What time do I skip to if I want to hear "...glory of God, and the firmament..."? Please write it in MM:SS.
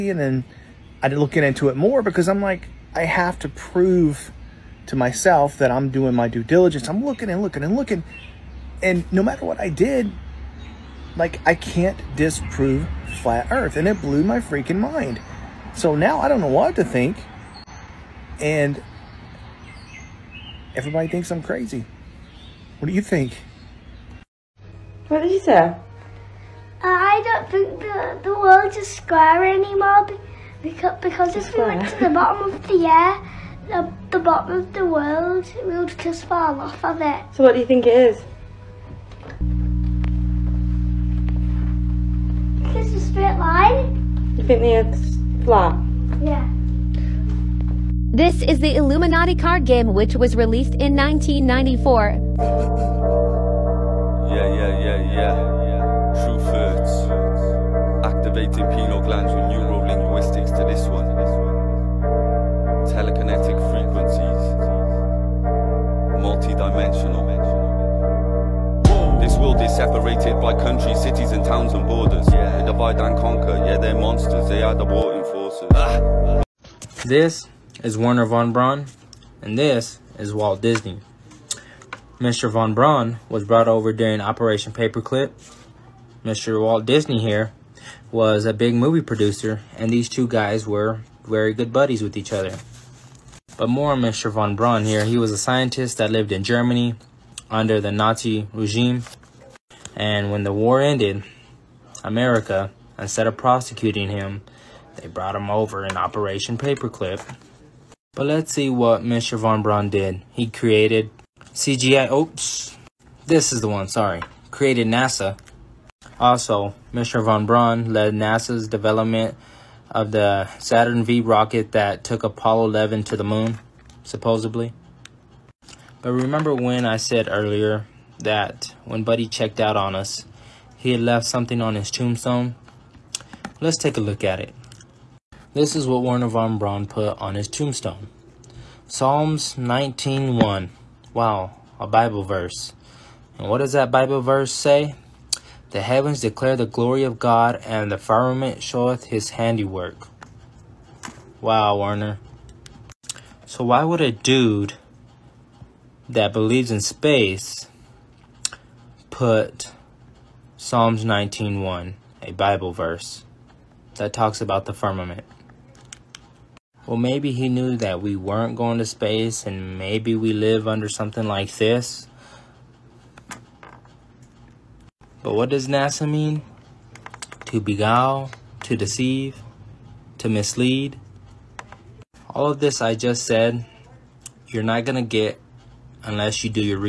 02:26.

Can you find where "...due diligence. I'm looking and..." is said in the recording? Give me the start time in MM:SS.
00:06.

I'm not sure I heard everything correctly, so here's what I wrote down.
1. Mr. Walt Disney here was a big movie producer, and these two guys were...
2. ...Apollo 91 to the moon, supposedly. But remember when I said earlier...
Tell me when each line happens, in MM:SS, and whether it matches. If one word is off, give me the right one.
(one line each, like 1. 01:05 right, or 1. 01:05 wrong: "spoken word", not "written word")
1. 01:26 right
2. 02:02 wrong: "11", not "91".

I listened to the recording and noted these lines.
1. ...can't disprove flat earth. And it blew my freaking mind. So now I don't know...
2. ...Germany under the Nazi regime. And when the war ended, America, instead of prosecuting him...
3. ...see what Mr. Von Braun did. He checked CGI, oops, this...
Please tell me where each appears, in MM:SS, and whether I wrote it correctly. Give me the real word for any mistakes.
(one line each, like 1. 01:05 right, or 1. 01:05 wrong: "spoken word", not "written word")
1. 00:11 right
2. 01:36 right
3. 01:48 wrong: "created", not "checked".